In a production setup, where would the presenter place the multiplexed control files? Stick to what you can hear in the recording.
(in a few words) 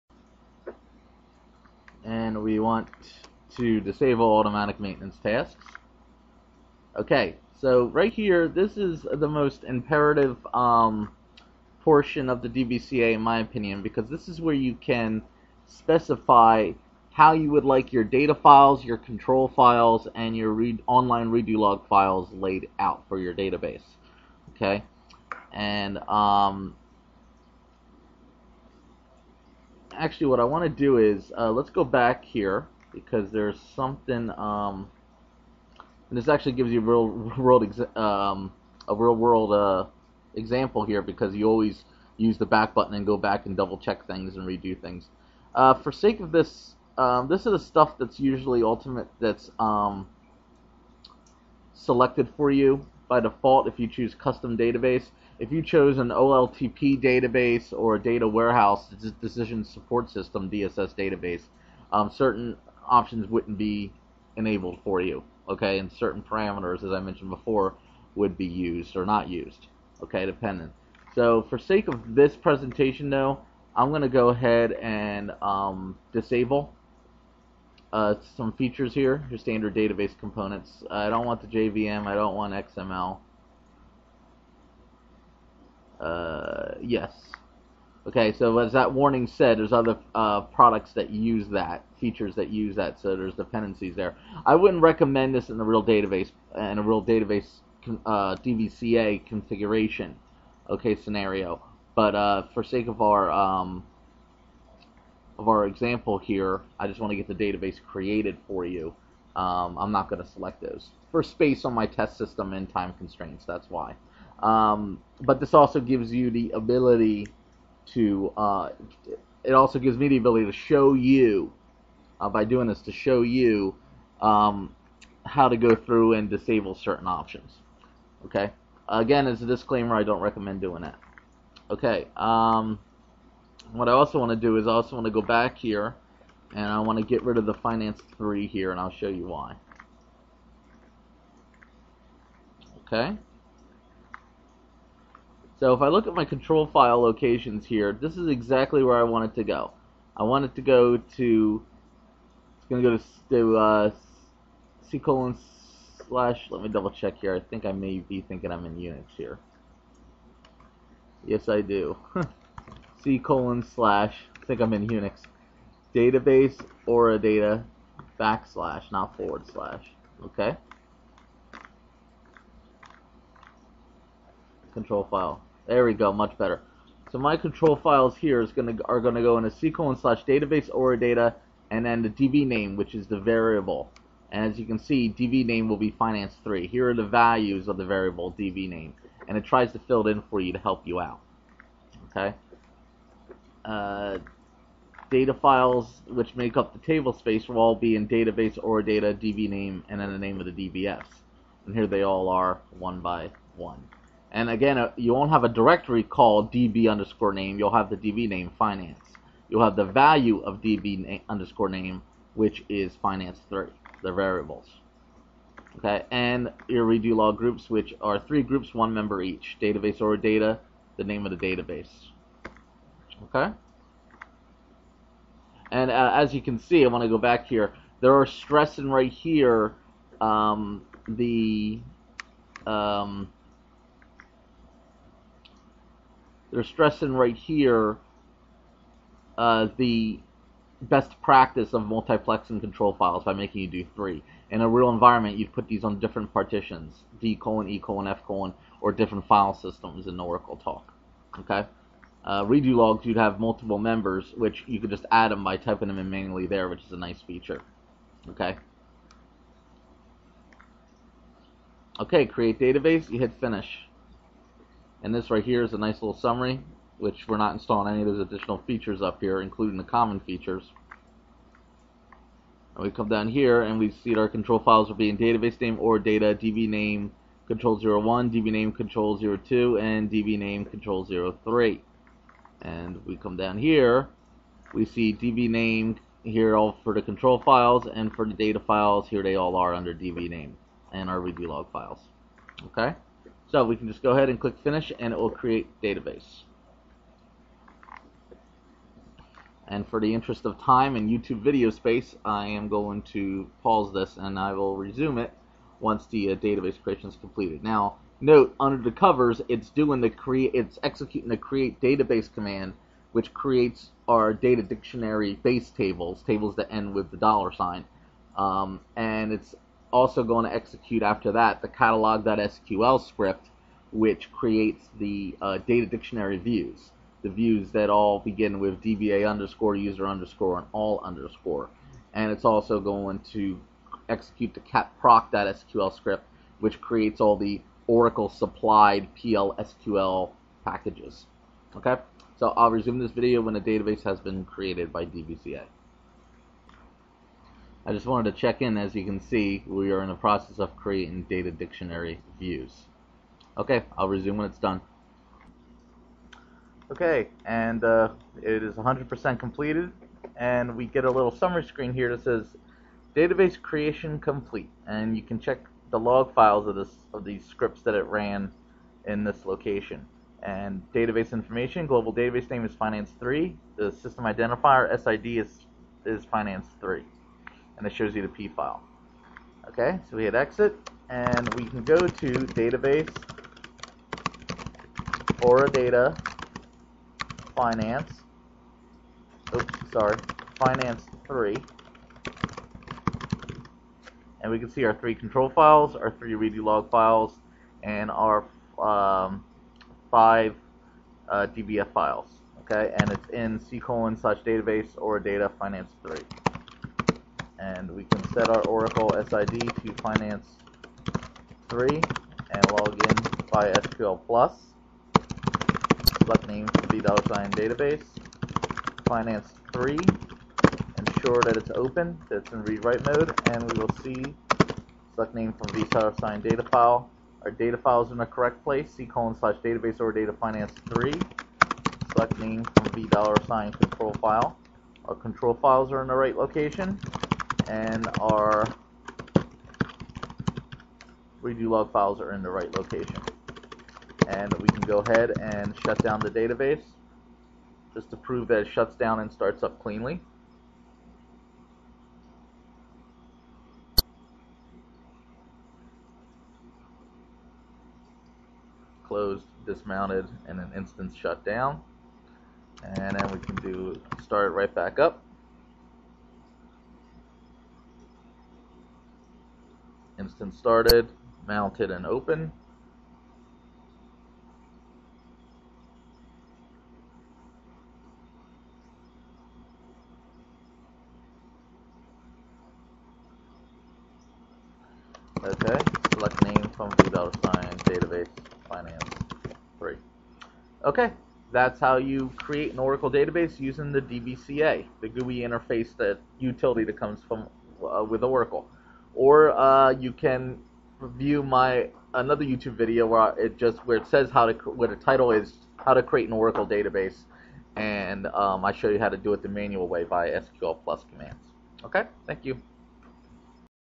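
different partitions.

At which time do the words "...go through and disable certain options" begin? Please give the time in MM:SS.
02:05.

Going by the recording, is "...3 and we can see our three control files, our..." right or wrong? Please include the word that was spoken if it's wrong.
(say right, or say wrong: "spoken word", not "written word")
right.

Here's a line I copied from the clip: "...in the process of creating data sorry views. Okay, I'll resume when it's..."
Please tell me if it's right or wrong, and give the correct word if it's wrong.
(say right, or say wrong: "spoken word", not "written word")
wrong: "dictionary", not "sorry".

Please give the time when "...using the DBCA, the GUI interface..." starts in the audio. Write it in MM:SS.
08:13.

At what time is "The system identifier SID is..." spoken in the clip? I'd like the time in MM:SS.
06:13.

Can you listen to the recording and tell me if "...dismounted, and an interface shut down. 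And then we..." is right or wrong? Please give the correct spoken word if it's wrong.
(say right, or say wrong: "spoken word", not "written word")
wrong: "instance", not "interface".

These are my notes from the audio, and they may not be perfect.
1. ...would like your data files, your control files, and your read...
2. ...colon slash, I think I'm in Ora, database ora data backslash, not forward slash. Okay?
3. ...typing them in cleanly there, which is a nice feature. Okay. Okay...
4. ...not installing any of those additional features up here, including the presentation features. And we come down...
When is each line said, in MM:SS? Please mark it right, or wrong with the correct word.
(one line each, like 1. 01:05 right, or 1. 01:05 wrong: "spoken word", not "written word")
1. 00:17 right
2. 02:43 wrong: "Unix", not "Ora"
3. 04:15 wrong: "manually", not "cleanly"
4. 04:27 wrong: "common", not "presentation".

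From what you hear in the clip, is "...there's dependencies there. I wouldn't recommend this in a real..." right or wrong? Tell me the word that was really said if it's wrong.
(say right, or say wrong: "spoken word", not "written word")
right.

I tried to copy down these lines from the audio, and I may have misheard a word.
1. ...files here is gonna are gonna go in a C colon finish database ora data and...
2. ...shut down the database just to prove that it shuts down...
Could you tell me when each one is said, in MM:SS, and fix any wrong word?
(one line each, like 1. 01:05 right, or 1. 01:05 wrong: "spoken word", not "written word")
1. 02:57 wrong: "slash", not "finish"
2. 07:25 right.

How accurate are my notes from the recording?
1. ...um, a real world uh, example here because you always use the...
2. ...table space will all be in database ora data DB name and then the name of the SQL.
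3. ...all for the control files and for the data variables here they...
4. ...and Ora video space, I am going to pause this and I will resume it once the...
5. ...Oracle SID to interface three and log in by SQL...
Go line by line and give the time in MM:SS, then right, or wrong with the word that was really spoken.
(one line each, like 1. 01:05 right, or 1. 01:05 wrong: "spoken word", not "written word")
1. 00:37 right
2. 03:16 wrong: "DBFs", not "SQL"
3. 04:46 wrong: "files", not "variables"
4. 05:00 wrong: "YouTube", not "Ora"
5. 06:48 wrong: "finance", not "interface".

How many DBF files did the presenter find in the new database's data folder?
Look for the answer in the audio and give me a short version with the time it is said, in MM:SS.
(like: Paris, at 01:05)
5, at 06:40.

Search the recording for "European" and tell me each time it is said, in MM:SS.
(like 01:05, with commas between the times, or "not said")
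not said.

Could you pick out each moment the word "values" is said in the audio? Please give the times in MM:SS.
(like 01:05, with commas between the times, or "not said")
03:07, 03:29.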